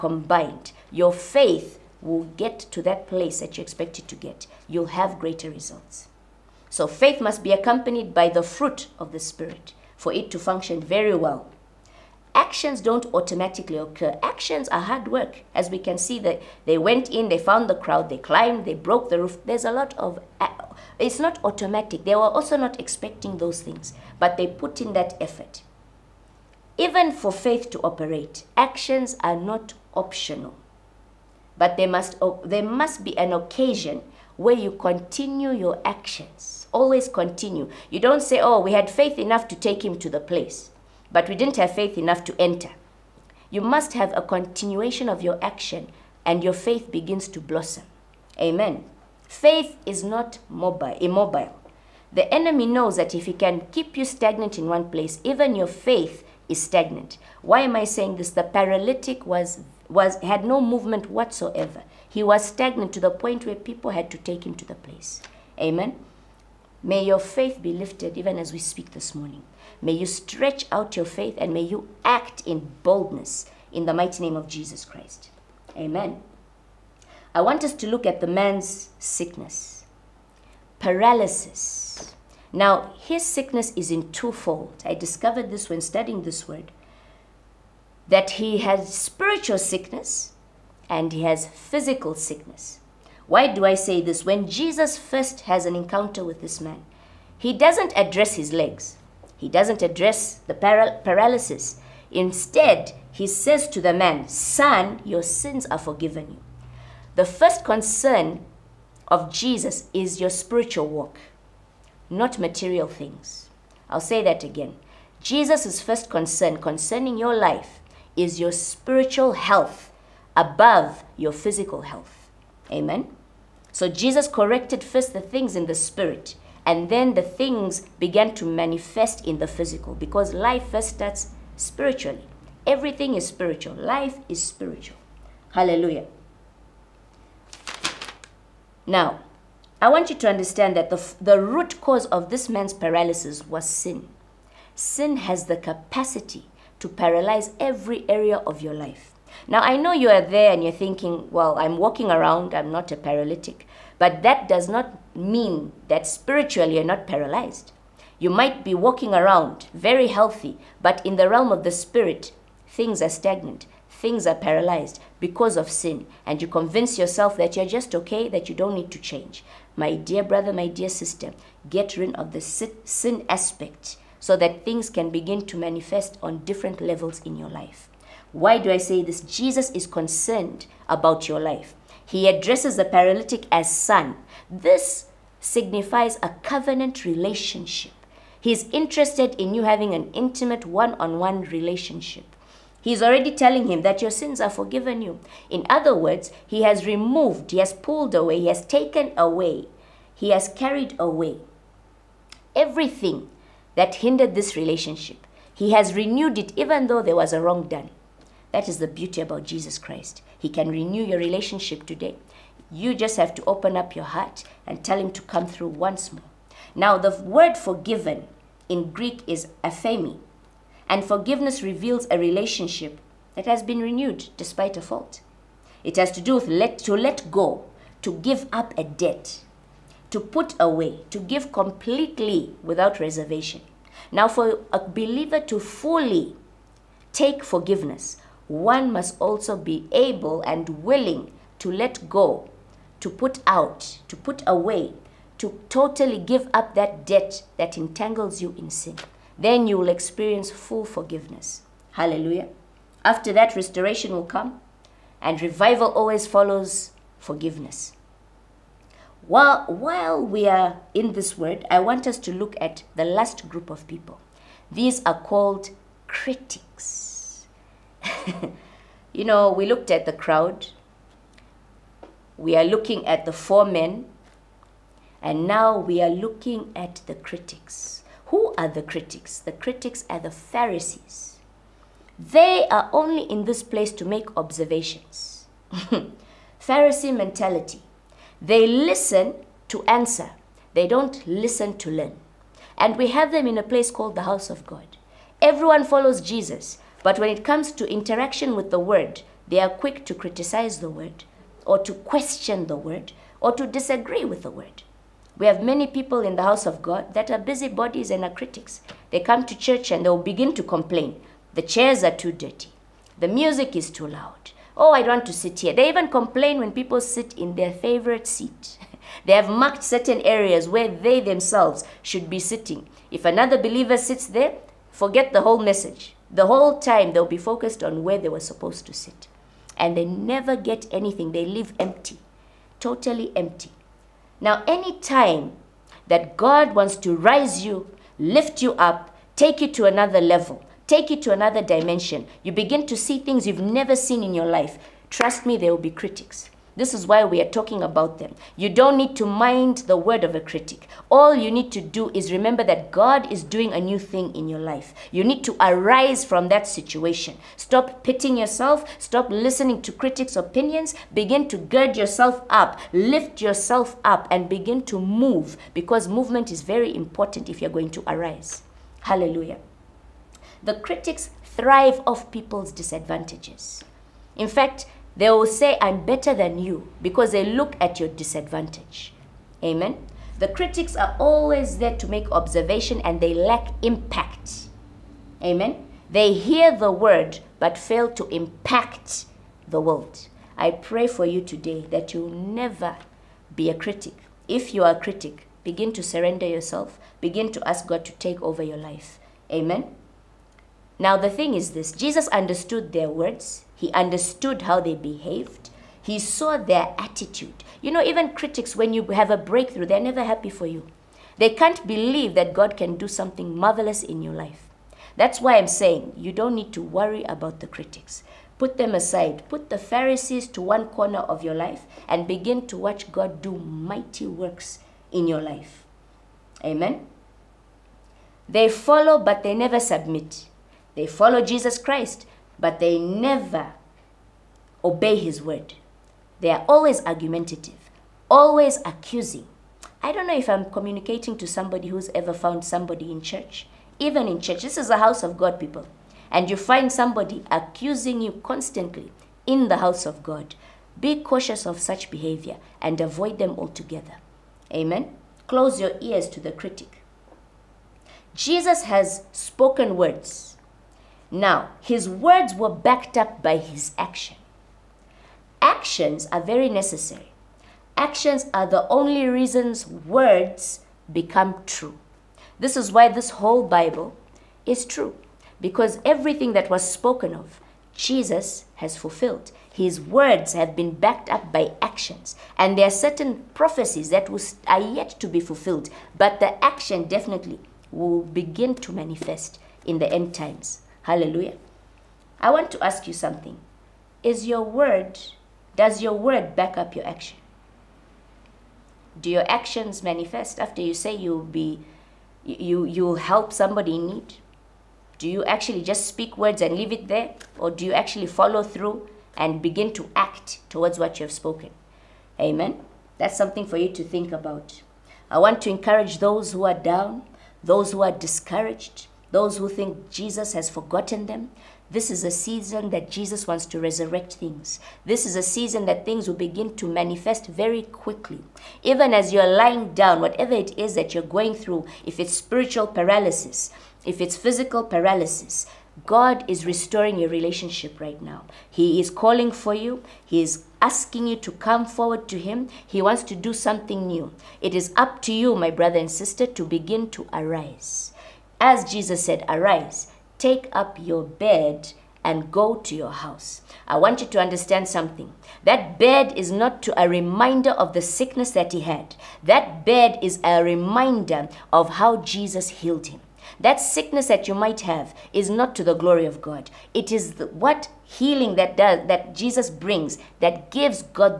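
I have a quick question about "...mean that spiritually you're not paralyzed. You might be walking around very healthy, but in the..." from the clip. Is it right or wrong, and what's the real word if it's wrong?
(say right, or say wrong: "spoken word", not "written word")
right.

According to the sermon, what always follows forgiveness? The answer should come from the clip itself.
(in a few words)
Revival.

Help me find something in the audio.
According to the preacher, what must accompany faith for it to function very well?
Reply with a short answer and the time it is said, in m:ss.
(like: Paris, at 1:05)
The fruit of the Spirit, at 0:08.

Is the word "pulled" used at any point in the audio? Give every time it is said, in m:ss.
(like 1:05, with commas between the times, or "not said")
3:17.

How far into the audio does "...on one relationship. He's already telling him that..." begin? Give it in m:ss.
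3:10.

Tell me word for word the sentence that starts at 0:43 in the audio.
You must have a continuation of your action, and your faith begins to blossom.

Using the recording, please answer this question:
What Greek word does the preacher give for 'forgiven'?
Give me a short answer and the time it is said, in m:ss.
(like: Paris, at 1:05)
Aphemi, at 3:39.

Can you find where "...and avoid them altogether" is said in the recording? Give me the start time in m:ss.
7:32.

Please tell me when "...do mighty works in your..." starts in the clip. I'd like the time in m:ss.
7:03.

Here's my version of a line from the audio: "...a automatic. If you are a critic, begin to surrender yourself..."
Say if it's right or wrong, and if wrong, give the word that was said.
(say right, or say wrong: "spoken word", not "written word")
wrong: "critic", not "automatic".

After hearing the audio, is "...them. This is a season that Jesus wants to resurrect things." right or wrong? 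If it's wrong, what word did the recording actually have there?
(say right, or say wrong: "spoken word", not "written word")
right.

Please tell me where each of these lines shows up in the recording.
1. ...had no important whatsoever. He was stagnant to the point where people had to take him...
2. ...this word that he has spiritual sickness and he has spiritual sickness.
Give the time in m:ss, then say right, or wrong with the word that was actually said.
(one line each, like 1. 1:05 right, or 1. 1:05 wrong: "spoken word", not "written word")
1. 1:00 wrong: "movement", not "important"
2. 1:26 wrong: "physical", not "spiritual".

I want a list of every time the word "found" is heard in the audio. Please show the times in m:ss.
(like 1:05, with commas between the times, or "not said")
0:17, 7:22.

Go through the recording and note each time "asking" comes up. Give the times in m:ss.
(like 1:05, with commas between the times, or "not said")
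9:00.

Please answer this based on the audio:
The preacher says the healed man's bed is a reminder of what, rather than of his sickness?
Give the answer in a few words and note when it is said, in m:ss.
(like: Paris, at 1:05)
How Jesus healed him, at 9:21.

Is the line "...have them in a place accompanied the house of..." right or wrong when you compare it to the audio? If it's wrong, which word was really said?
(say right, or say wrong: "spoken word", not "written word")
wrong: "called", not "accompanied".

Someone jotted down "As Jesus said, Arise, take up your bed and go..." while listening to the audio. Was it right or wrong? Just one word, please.
right.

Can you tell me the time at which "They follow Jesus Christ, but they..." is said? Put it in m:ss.
7:10.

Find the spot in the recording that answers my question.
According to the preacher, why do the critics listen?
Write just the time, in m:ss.
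4:49.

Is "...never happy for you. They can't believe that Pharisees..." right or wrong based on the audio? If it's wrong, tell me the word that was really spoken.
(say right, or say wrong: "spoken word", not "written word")
wrong: "God", not "Pharisees".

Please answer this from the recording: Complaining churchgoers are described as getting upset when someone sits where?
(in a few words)
In their favorite seat.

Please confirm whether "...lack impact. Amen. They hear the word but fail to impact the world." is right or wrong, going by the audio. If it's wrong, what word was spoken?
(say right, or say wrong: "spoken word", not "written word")
right.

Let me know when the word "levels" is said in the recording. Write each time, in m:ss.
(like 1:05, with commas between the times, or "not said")
2:56, 5:40.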